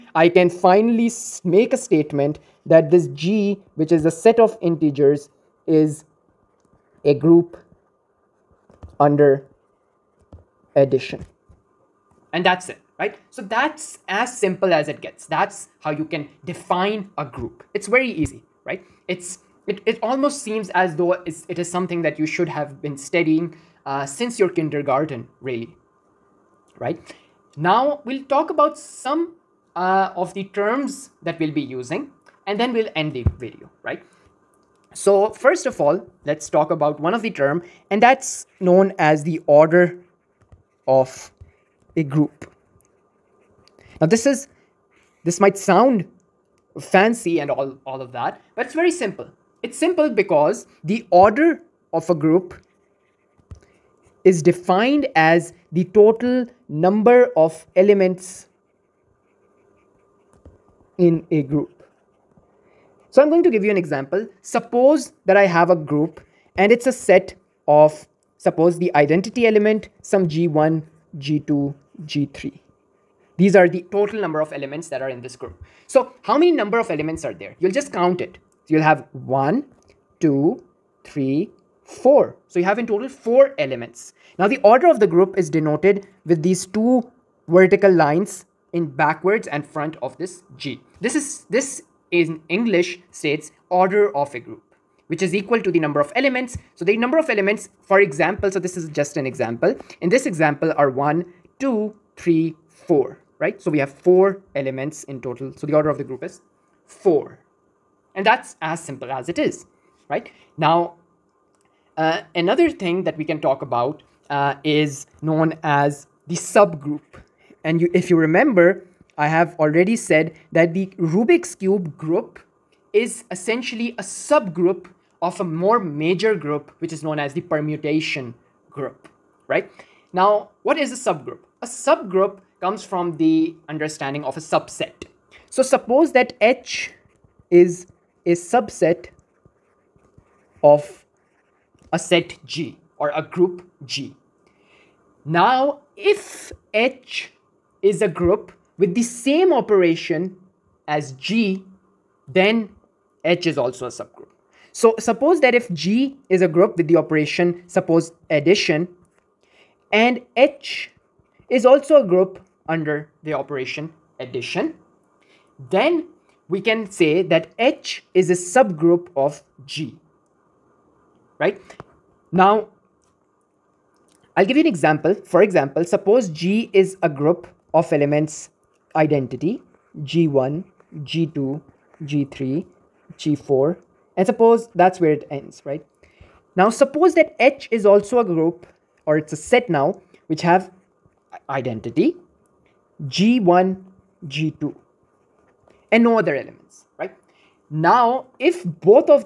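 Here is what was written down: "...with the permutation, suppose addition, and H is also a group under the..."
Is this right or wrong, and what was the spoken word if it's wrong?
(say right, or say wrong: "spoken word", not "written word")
wrong: "operation", not "permutation".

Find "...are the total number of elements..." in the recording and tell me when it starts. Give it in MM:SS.
01:13.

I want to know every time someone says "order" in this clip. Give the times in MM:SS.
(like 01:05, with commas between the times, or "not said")
00:39, 00:51, 01:24, 01:33, 01:45.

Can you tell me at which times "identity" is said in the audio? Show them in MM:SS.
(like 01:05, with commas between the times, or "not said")
01:08, 02:58, 03:11.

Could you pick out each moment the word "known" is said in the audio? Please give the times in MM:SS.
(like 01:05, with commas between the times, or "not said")
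00:38, 01:55, 02:07.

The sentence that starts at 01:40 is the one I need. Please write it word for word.
In this example are one, two, three, four.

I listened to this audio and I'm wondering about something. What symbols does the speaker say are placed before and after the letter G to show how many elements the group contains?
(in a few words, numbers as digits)
two vertical lines.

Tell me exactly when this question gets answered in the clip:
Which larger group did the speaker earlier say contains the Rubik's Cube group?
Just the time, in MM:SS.
02:07.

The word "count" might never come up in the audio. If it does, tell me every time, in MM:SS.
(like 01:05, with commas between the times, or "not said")
01:17.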